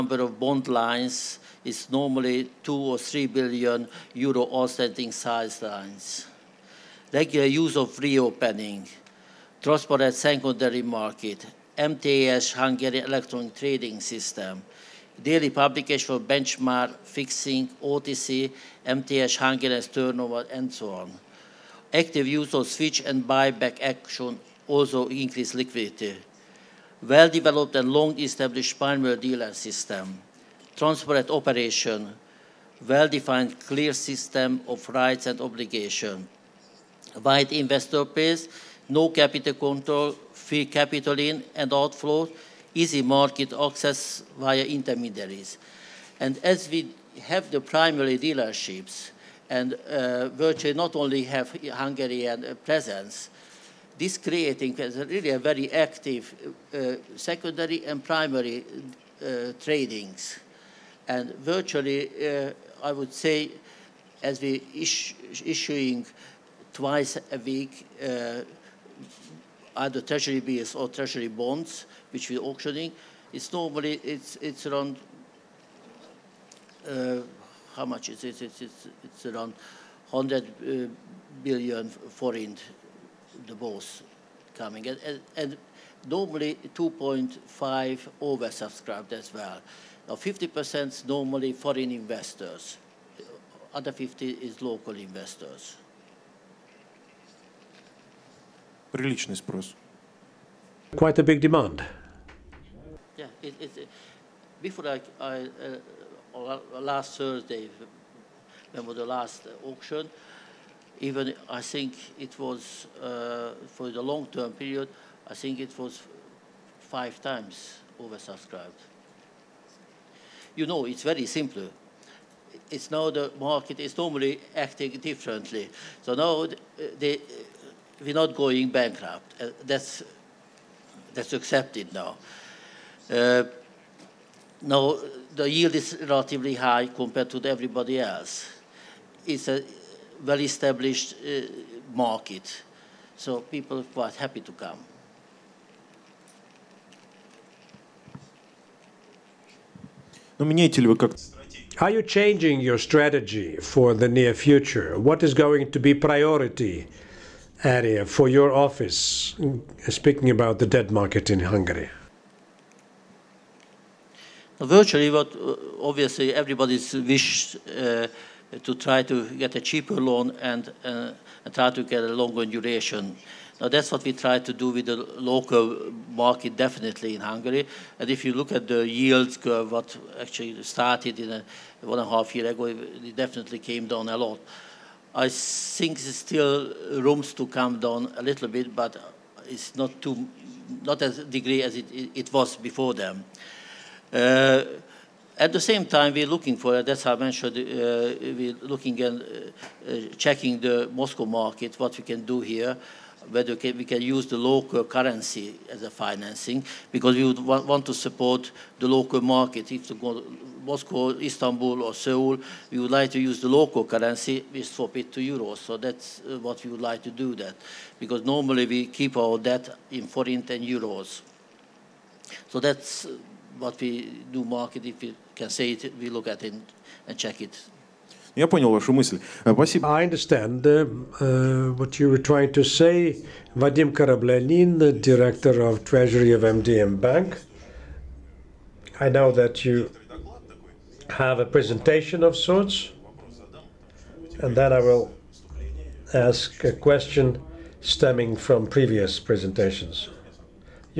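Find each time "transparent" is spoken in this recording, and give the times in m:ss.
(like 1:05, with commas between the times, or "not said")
0:09, 0:30.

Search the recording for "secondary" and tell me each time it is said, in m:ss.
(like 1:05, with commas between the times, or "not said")
0:10, 0:57.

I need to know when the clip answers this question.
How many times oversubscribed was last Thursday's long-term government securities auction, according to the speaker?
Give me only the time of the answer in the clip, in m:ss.
1:56.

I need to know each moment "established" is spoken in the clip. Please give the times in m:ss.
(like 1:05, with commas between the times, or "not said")
0:27, 2:20.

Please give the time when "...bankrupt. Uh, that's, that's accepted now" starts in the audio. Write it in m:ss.
2:08.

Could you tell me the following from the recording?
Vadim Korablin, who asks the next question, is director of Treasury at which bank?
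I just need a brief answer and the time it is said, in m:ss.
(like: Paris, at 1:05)
MDM Bank, at 3:56.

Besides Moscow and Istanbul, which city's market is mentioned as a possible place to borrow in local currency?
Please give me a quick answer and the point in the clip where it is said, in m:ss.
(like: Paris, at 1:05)
Seoul, at 3:31.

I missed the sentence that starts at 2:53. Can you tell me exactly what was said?
Now that's what we try to do with the local market definitely in Hungary.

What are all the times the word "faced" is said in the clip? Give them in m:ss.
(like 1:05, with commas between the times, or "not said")
not said.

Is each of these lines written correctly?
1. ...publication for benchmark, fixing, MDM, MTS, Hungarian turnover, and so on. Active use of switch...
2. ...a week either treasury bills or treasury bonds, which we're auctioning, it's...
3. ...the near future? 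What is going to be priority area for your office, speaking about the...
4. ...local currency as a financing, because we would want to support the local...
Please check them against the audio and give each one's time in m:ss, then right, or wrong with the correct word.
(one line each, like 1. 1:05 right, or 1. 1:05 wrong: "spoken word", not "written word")
1. 0:15 wrong: "OTC", not "MDM"
2. 1:07 right
3. 2:33 right
4. 3:24 right.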